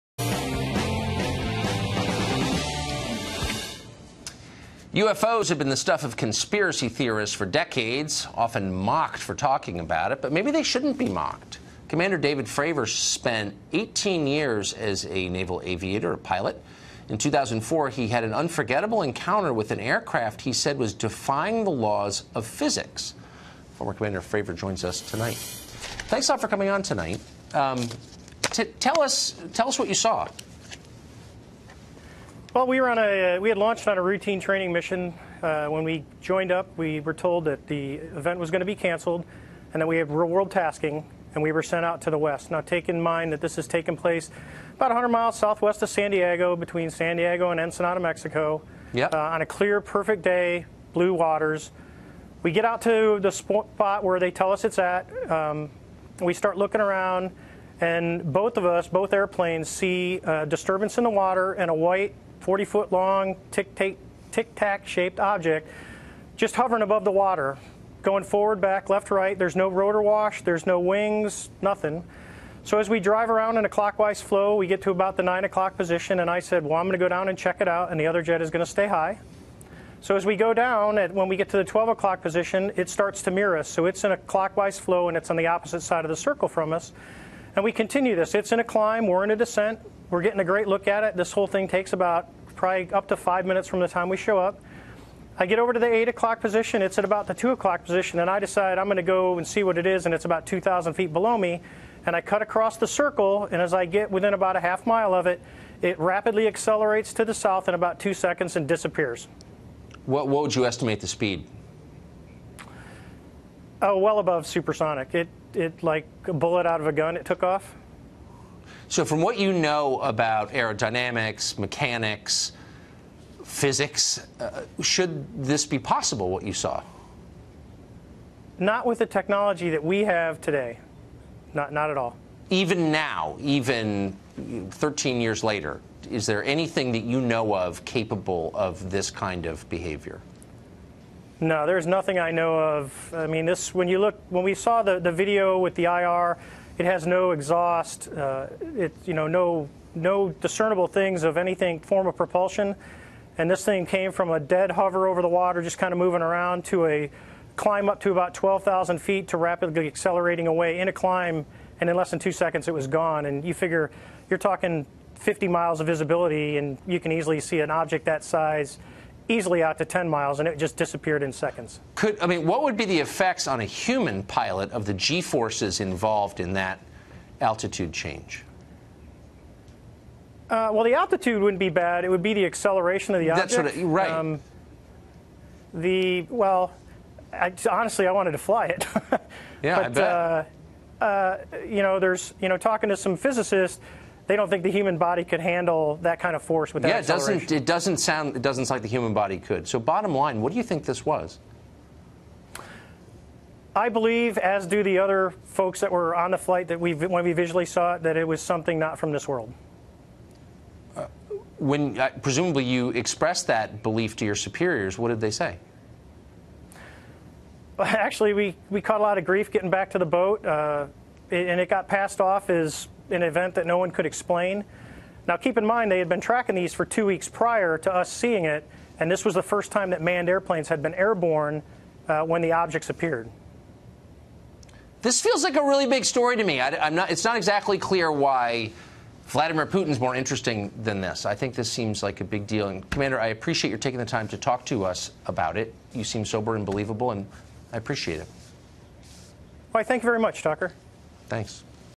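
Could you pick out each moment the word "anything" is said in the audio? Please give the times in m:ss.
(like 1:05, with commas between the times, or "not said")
2:16, 2:31.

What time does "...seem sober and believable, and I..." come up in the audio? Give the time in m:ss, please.
4:06.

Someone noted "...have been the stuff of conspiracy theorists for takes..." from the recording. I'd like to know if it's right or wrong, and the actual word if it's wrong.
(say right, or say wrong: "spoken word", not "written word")
wrong: "decades", not "takes".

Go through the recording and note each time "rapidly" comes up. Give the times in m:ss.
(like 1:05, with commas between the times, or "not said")
1:45, 2:39.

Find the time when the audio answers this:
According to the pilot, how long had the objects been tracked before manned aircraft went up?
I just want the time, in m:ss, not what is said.
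3:46.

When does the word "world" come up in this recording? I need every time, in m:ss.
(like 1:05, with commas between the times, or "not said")
0:40, 3:29.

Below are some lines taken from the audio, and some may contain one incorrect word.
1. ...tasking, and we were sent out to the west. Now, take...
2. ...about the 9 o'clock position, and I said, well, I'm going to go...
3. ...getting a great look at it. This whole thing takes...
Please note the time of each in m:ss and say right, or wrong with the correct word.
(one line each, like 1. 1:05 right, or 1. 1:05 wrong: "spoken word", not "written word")
1. 0:40 right
2. 1:14 right
3. 1:30 right.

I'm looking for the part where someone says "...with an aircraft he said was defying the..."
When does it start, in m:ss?
0:19.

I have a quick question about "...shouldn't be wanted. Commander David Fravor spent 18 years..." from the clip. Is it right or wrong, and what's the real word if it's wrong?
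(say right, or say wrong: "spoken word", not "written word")
wrong: "mocked", not "wanted".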